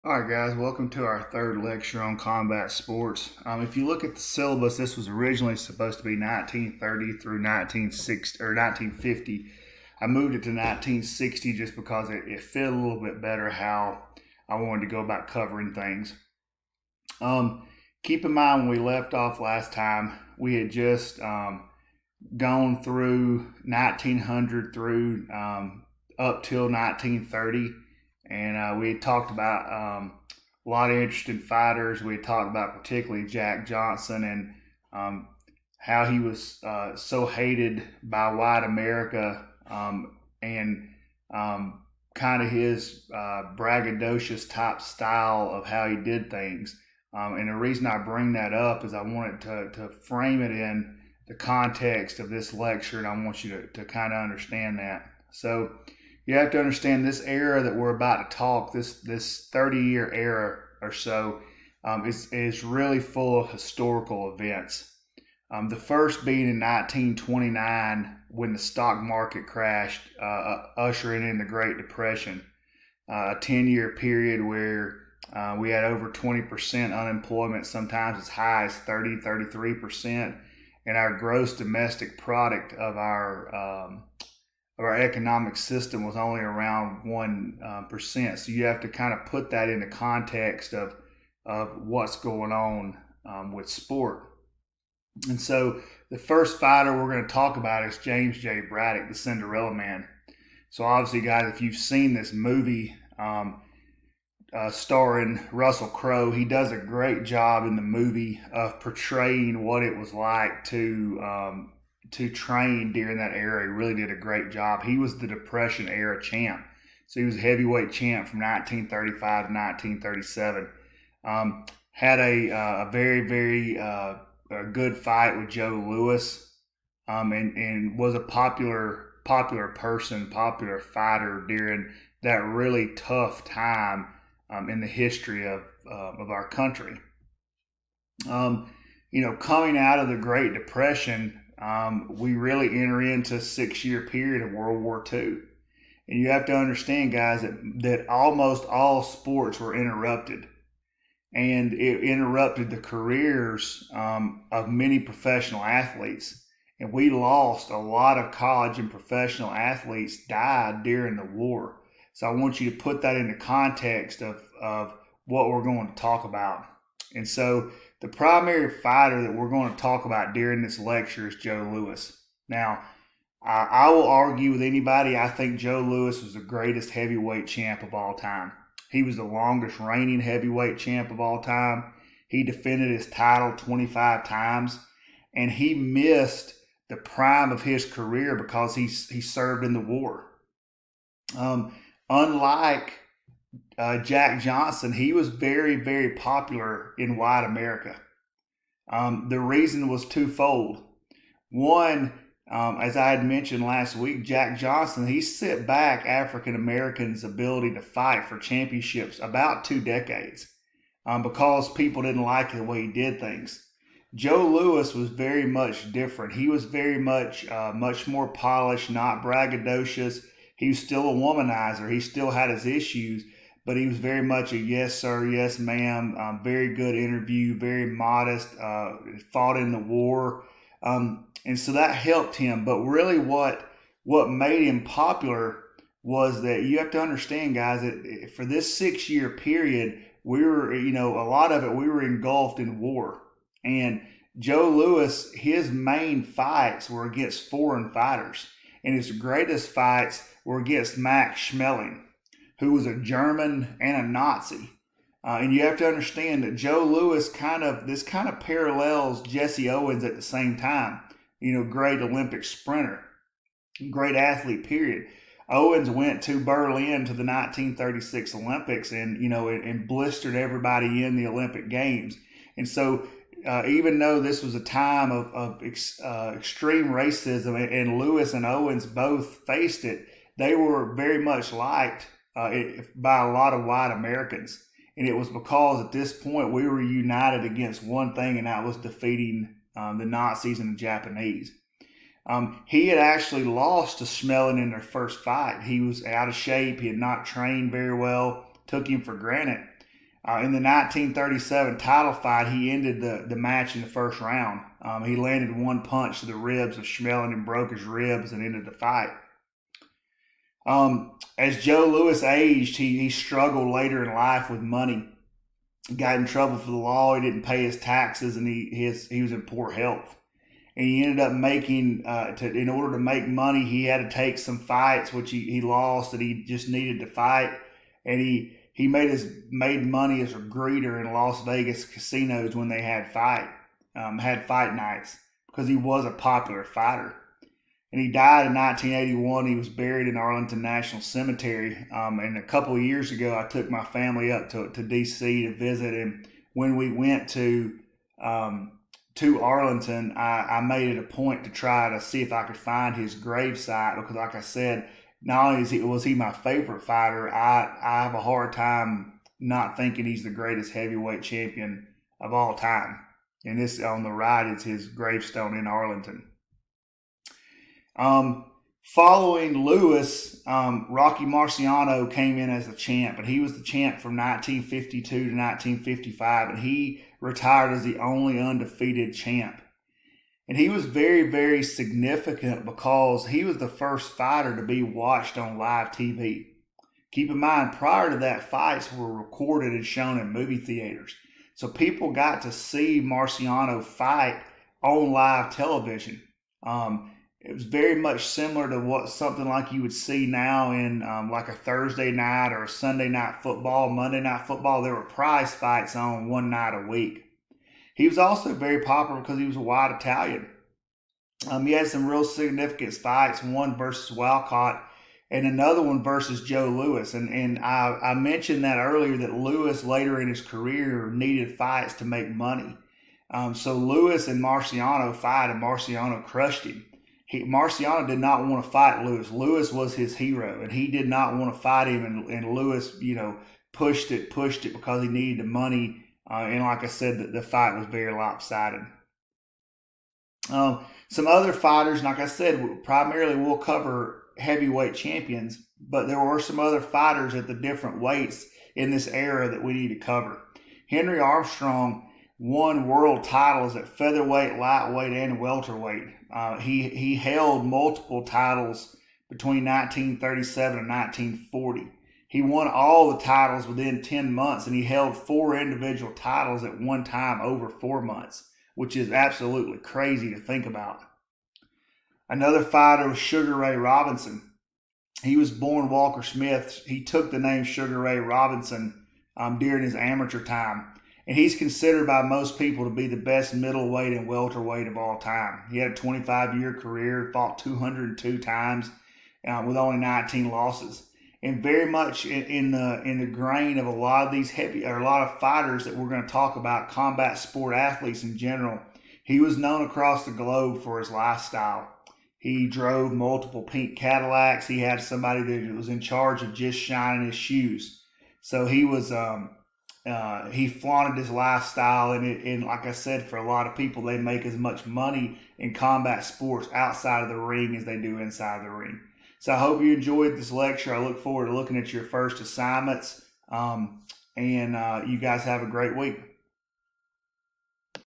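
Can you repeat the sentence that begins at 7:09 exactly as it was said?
Louis was his hero, and he did not want to fight him.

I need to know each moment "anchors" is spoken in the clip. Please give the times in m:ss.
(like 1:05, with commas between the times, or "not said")
not said.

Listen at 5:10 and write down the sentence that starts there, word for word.
Um, as Joe Louis aged, he, he struggled later in life with money.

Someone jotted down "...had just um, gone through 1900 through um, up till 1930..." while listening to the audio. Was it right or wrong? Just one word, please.
right.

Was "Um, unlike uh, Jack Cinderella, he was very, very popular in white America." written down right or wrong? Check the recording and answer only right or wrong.
wrong.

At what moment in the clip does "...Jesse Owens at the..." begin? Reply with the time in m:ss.
4:19.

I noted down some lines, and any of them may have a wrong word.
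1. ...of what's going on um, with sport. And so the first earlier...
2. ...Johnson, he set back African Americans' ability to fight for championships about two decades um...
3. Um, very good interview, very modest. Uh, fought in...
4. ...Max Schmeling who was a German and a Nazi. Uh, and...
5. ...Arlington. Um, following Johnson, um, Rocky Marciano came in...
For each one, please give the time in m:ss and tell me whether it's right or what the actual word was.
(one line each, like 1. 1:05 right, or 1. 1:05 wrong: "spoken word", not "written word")
1. 1:31 wrong: "fighter", not "earlier"
2. 3:24 right
3. 3:46 right
4. 4:10 right
5. 6:05 wrong: "Louis", not "Johnson".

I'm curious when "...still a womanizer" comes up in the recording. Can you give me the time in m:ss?
3:40.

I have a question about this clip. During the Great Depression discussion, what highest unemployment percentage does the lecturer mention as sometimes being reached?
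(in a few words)
33%.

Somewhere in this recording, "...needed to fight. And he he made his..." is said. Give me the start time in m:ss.
5:26.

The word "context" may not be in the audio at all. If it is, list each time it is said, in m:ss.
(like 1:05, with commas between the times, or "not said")
0:51, 1:29, 2:43.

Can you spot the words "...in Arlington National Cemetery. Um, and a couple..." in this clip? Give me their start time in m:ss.
5:40.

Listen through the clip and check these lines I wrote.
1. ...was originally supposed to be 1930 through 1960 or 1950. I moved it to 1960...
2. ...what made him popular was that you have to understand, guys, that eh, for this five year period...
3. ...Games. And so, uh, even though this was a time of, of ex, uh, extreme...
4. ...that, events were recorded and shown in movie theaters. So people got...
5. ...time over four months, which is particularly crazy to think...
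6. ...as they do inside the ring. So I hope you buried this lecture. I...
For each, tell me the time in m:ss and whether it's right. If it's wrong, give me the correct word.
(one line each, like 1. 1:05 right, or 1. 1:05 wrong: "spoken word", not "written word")
1. 0:04 right
2. 3:54 wrong: "six", not "five"
3. 4:31 right
4. 6:28 wrong: "fights", not "events"
5. 7:47 wrong: "absolutely", not "particularly"
6. 8:37 wrong: "enjoyed", not "buried".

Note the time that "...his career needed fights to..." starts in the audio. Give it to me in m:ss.
7:00.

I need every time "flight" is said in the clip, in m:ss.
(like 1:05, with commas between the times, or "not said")
not said.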